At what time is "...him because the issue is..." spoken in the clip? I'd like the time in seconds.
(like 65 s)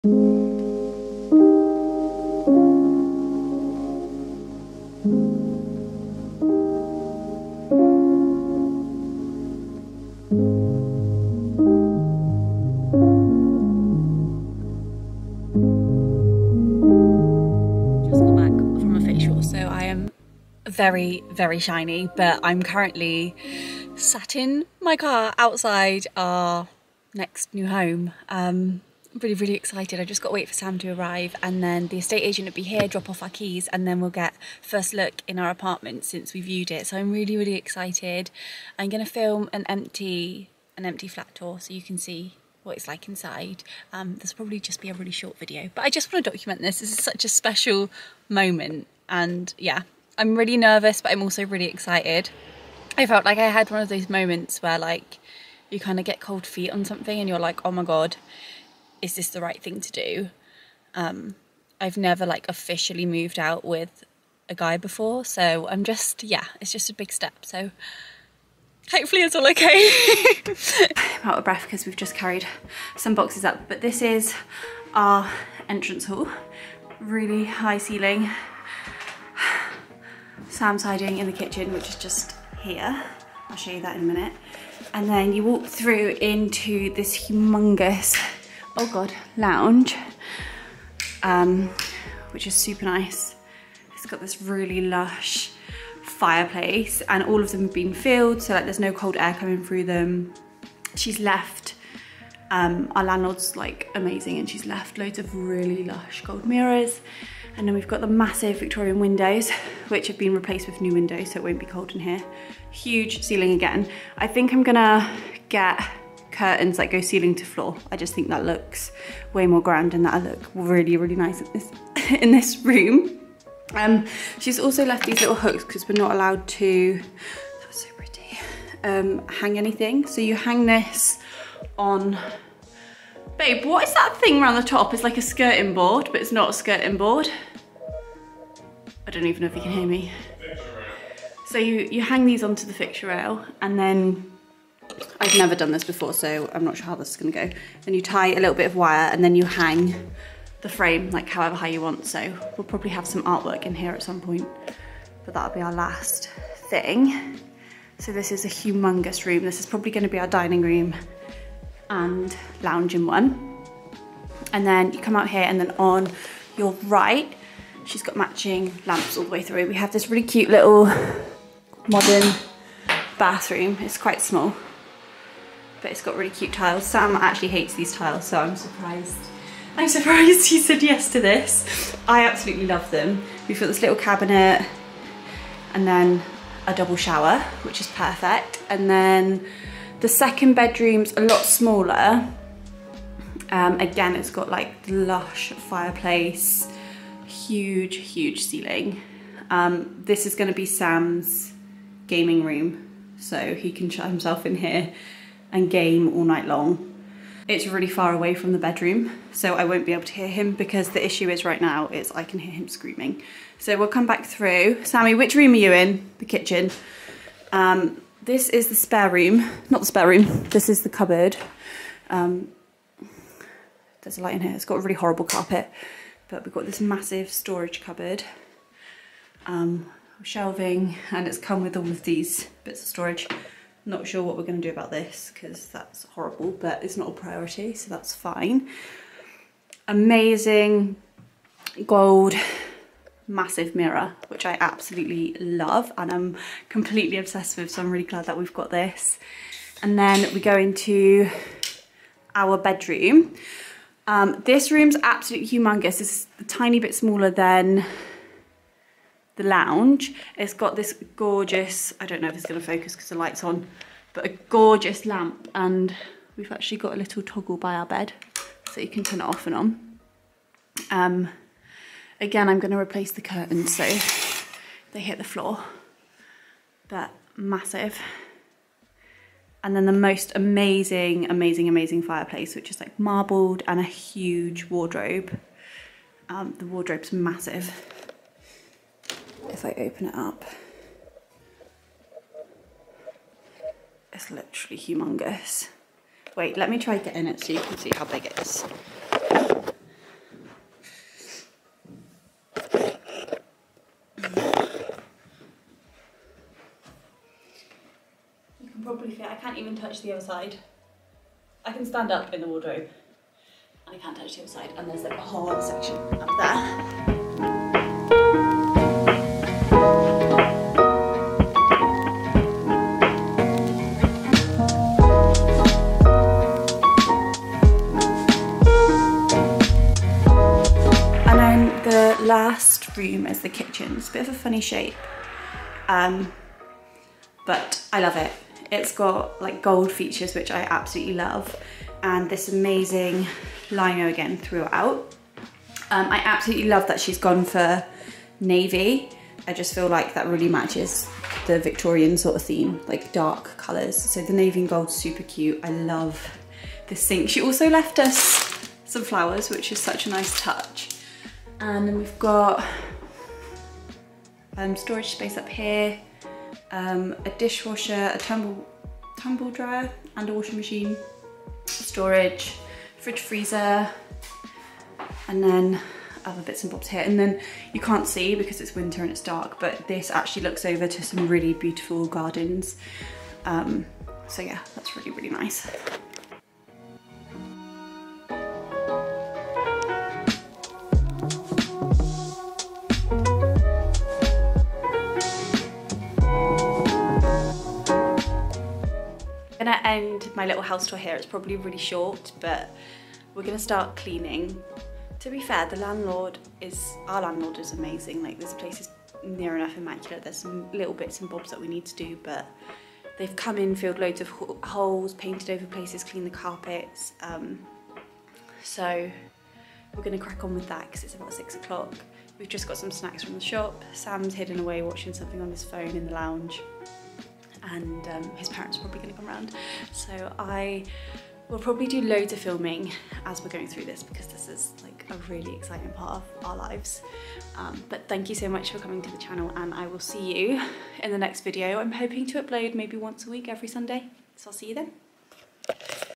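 210 s.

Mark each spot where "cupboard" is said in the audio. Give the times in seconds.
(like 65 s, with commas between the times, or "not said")
220 s, 227 s.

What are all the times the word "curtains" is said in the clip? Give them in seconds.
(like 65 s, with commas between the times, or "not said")
116 s, 273 s.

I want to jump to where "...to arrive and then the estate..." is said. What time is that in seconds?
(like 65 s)
30 s.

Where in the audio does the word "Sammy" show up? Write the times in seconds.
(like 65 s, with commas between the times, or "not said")
214 s.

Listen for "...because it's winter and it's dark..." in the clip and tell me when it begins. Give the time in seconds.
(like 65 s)
378 s.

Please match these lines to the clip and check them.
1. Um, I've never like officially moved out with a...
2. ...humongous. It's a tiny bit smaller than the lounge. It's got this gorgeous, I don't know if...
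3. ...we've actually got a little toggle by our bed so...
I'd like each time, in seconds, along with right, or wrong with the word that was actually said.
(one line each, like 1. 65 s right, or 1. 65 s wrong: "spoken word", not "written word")
1. 60 s right
2. 255 s right
3. 266 s right.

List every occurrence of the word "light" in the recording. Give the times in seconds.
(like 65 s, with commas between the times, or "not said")
224 s, 263 s.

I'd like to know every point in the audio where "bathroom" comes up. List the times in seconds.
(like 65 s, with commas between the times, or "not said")
173 s.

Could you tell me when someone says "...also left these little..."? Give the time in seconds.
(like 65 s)
124 s.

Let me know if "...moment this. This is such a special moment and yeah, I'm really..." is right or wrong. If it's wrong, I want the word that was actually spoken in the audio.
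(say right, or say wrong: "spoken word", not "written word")
wrong: "document", not "moment".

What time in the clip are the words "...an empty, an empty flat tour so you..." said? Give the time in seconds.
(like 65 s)
39 s.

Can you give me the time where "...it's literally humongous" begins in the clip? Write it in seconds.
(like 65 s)
294 s.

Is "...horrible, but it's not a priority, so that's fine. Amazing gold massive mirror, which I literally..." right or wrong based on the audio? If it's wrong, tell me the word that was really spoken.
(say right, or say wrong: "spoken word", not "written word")
wrong: "absolutely", not "literally".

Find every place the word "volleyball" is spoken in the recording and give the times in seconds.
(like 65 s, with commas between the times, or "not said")
not said.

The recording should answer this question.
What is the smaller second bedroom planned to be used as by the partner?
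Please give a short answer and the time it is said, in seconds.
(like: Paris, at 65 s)
Gaming room, at 202 s.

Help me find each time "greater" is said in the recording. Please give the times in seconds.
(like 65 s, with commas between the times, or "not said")
not said.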